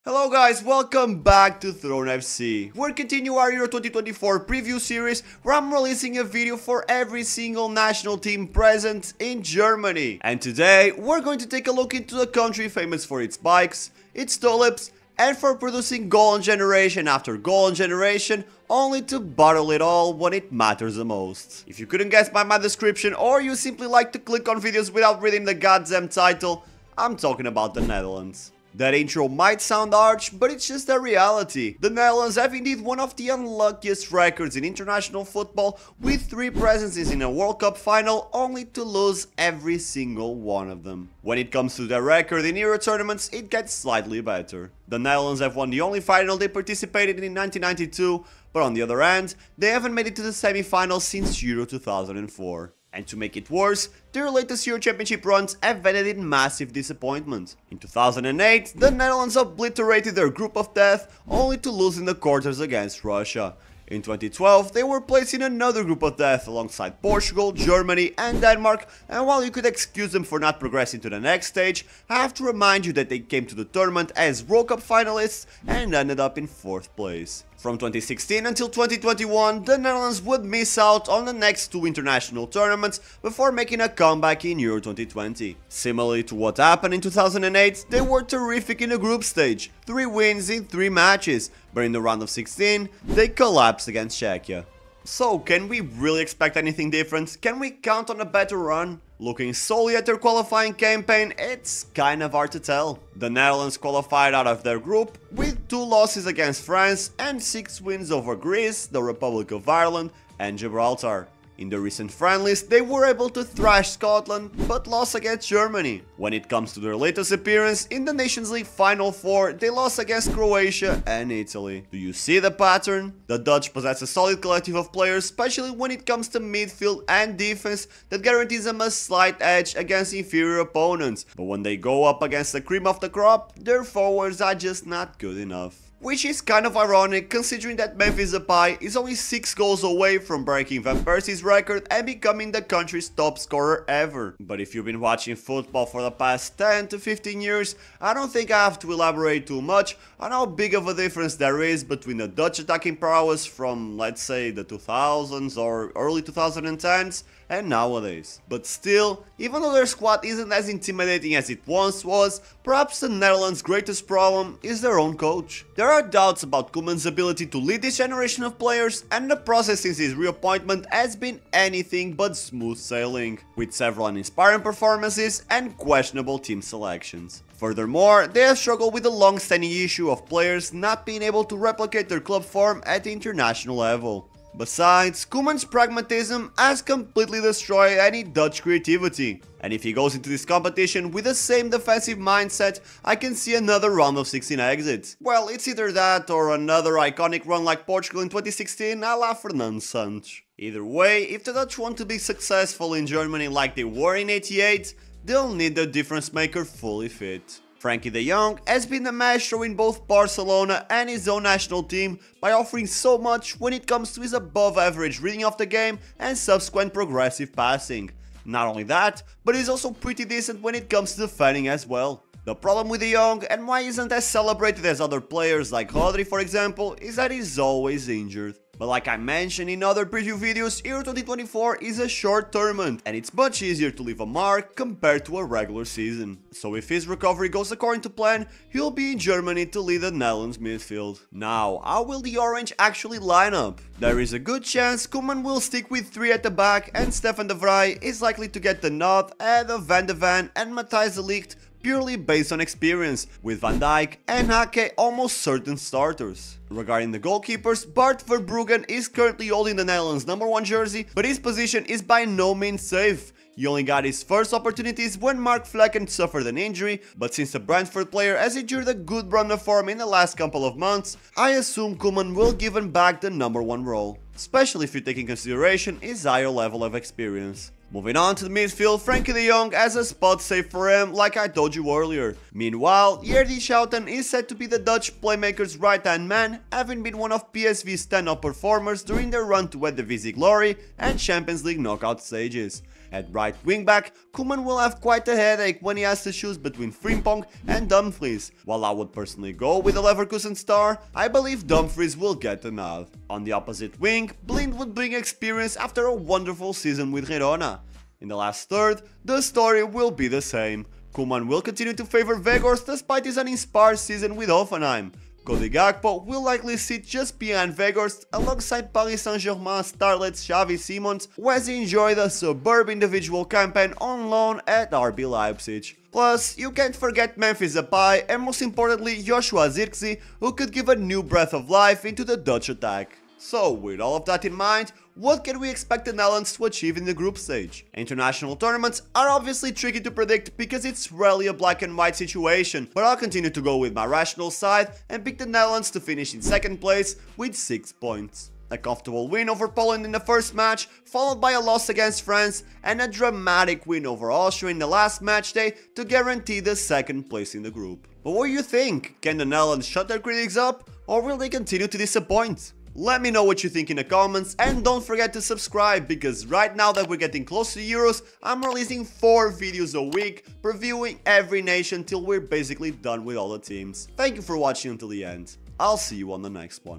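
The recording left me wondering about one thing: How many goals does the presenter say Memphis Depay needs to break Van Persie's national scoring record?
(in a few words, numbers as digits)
6.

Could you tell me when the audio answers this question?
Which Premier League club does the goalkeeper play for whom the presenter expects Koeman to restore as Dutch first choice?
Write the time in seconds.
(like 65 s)
267 s.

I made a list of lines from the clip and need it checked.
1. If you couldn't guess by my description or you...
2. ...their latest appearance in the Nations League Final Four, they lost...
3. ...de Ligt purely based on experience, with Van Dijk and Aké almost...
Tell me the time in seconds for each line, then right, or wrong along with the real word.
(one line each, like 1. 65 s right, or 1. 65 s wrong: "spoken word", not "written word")
1. 21 s right
2. 116 s right
3. 251 s right.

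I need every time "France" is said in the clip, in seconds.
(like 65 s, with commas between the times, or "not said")
106 s, 352 s.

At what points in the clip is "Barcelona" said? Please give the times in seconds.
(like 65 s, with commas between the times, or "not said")
210 s.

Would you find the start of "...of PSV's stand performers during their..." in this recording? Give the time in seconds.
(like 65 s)
287 s.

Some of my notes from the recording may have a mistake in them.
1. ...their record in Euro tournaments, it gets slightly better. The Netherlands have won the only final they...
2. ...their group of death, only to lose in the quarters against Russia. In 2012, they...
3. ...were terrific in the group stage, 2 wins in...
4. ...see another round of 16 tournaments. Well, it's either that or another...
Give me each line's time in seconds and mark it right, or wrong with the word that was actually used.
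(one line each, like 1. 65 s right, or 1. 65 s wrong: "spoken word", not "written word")
1. 41 s right
2. 60 s right
3. 88 s wrong: "3", not "2"
4. 193 s wrong: "exits", not "tournaments".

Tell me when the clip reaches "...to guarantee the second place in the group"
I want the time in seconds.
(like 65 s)
355 s.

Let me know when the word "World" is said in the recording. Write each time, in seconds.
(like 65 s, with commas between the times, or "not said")
37 s, 74 s.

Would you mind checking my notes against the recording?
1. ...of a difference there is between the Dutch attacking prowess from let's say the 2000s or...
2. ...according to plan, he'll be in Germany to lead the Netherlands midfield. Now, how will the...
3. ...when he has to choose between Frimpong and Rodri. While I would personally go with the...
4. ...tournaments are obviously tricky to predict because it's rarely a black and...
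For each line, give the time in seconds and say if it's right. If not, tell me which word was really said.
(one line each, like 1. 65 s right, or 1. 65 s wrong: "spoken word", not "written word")
1. 150 s right
2. 237 s right
3. 295 s wrong: "Dumfries", not "Rodri"
4. 338 s right.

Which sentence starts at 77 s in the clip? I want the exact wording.
From 2016 until 2021, the Netherlands would miss out on the next two international tournaments before making a comeback in Euro 2020.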